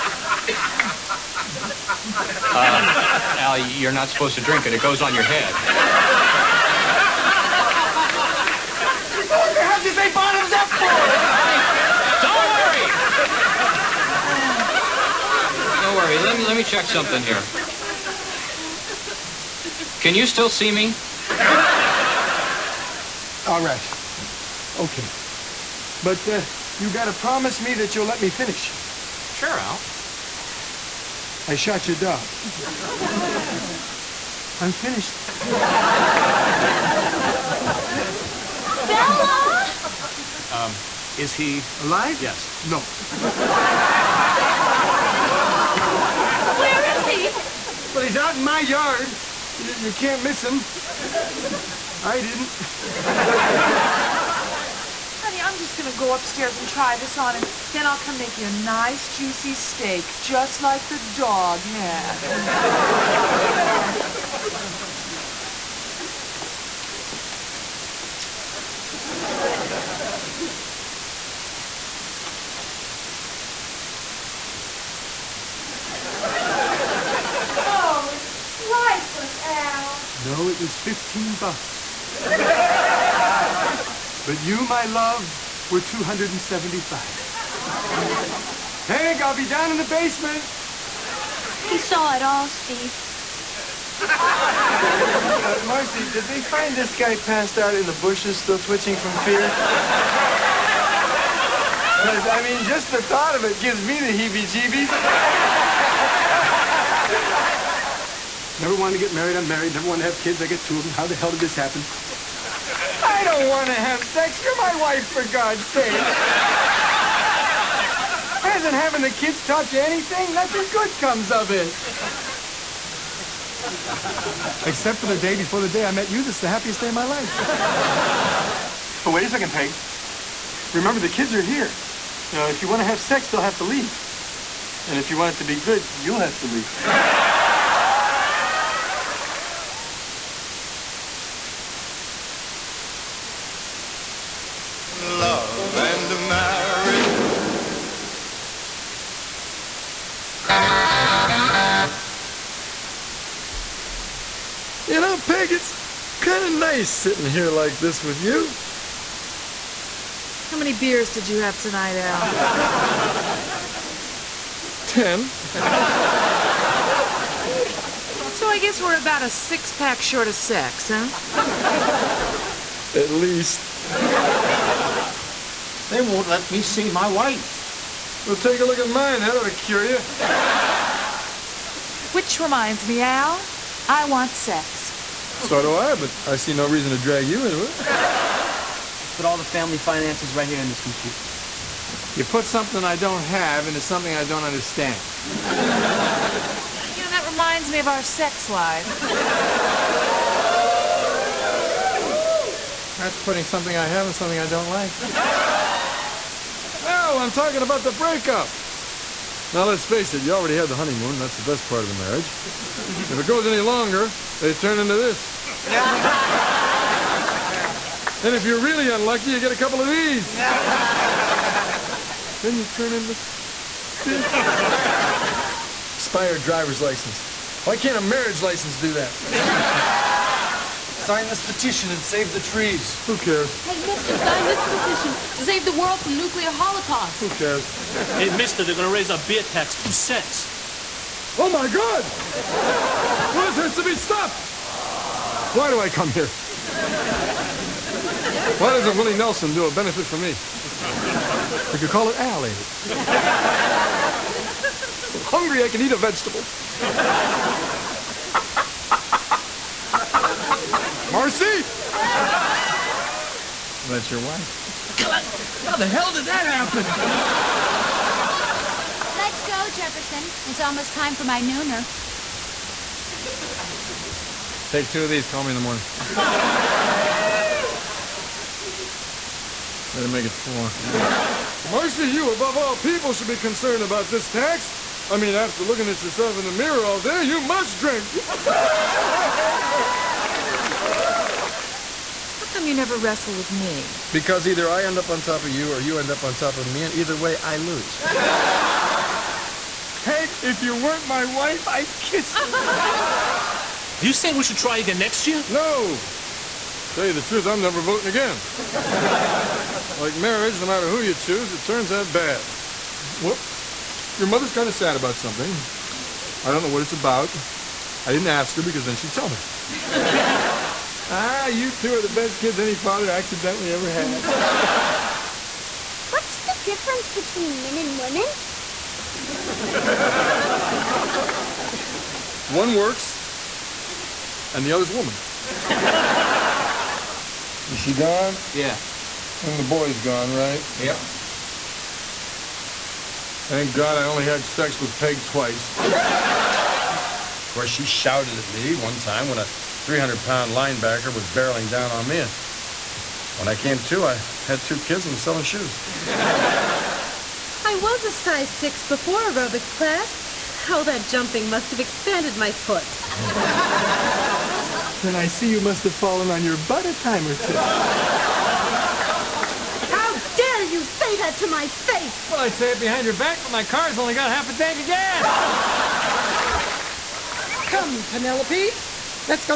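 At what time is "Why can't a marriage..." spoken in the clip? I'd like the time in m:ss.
3:47.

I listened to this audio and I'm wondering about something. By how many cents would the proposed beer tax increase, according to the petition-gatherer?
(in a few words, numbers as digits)
2 cents.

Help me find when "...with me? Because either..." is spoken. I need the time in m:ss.
4:53.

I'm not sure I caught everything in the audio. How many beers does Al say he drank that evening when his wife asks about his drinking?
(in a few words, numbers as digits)
10.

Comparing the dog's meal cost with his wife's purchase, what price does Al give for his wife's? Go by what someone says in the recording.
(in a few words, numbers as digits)
275.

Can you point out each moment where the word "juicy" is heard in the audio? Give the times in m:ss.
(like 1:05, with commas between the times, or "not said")
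0:59.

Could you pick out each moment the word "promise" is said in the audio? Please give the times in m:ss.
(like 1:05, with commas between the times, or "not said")
0:27.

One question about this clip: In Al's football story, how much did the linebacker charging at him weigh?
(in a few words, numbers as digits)
300 pounds.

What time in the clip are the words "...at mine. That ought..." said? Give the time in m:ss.
2:58.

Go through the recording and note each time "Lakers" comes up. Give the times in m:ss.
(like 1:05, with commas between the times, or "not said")
not said.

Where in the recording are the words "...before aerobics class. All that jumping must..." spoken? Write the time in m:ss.
5:58.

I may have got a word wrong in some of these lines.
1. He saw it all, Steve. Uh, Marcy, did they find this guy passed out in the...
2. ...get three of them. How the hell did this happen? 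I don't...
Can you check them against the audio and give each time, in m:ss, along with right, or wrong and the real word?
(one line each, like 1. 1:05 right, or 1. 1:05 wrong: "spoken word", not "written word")
1. 1:31 right
2. 1:50 wrong: "two", not "three".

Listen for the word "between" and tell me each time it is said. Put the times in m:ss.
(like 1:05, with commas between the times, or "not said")
5:27.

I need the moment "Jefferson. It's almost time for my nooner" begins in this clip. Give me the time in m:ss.
4:29.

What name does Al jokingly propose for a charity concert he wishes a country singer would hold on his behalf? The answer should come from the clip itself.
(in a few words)
Al Aid.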